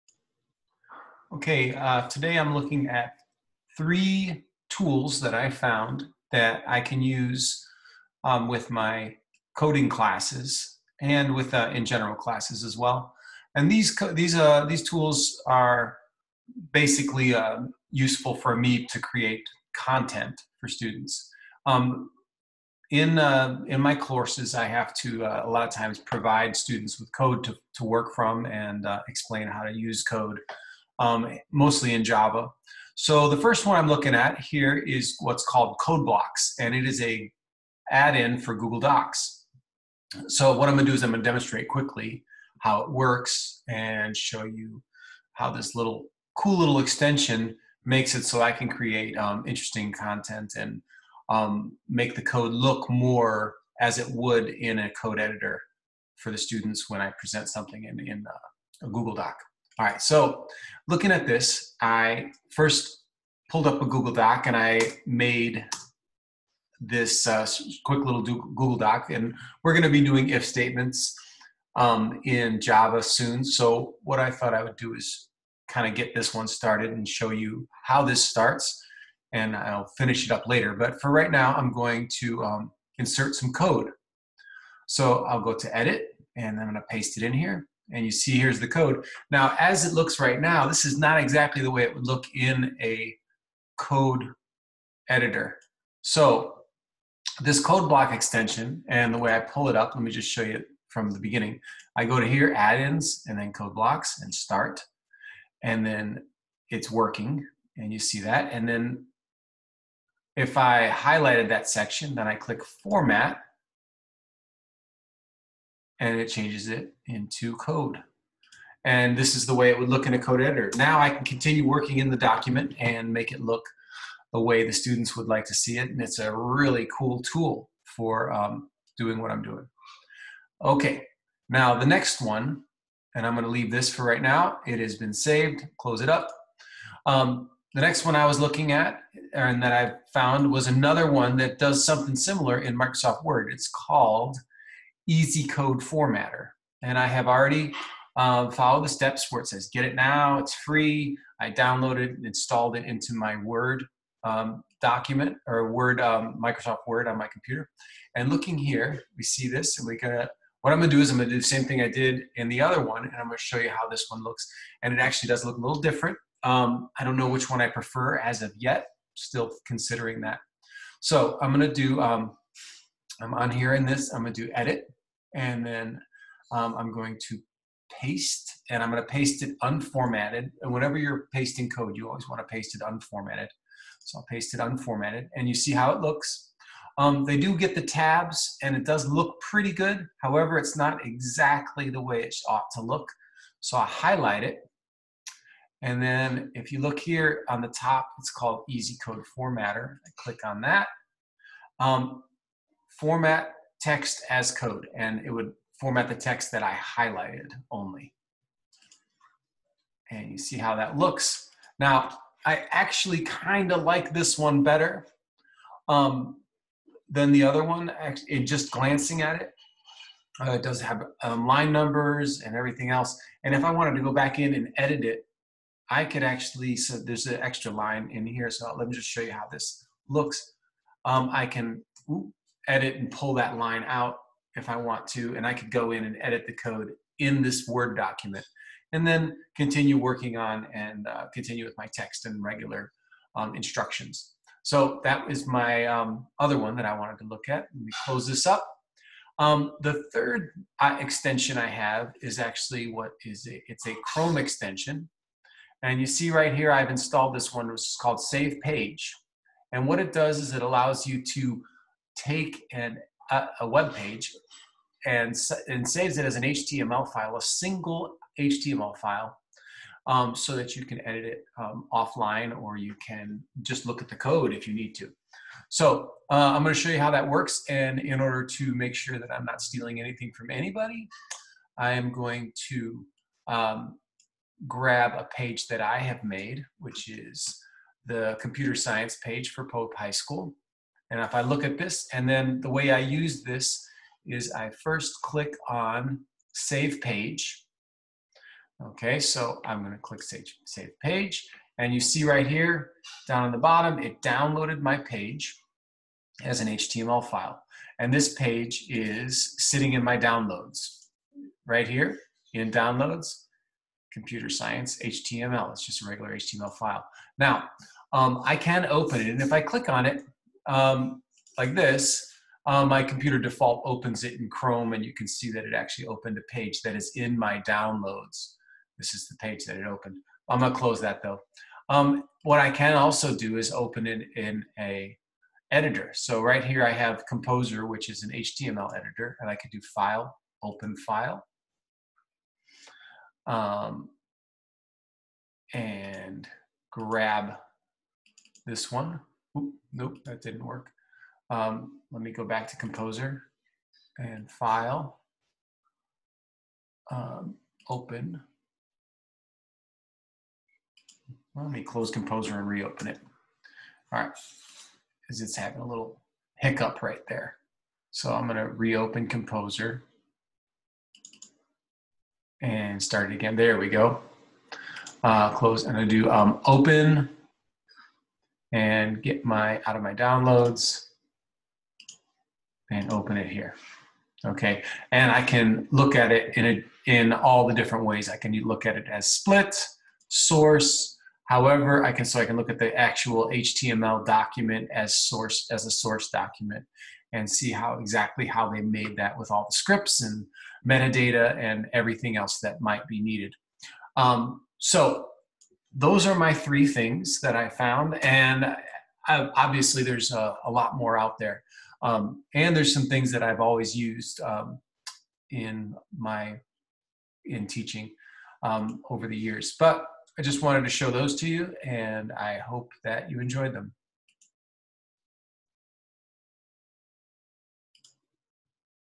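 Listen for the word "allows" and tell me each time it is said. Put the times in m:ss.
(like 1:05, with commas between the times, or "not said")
4:20.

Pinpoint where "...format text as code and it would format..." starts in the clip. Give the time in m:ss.
3:22.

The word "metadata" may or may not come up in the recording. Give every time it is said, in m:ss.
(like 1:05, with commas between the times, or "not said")
6:40.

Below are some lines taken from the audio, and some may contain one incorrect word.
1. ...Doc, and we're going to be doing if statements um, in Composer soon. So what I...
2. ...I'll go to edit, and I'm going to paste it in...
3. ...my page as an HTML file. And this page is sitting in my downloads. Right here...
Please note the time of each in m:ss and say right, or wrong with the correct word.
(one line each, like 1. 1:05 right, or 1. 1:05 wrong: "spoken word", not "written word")
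1. 1:08 wrong: "Java", not "Composer"
2. 1:25 right
3. 5:04 right.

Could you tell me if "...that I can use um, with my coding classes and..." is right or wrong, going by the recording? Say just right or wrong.
right.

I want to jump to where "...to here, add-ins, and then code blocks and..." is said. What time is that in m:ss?
1:42.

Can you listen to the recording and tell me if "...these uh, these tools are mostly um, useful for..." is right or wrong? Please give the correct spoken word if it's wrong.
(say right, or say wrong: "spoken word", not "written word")
wrong: "basically", not "mostly".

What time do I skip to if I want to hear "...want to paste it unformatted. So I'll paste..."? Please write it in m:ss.
3:02.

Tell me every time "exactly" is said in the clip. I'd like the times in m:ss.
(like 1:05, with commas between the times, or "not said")
1:31, 3:11, 6:37.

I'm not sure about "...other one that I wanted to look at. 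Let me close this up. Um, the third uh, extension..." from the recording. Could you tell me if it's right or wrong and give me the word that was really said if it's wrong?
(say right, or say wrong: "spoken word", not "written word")
right.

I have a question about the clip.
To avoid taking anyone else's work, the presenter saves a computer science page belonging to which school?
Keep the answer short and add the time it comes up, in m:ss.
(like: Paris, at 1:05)
Pope High School, at 4:49.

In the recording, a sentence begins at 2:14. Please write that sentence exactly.
It has been saved, close it up.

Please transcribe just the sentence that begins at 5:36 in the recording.
So right here I have Composer, which is an HTML editor, and I could do File, Open File.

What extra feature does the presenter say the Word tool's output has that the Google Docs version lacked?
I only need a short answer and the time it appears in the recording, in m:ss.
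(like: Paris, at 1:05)
line numbers, at 3:41.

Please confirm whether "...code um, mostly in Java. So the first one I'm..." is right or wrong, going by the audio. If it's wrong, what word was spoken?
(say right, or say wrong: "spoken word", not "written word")
right.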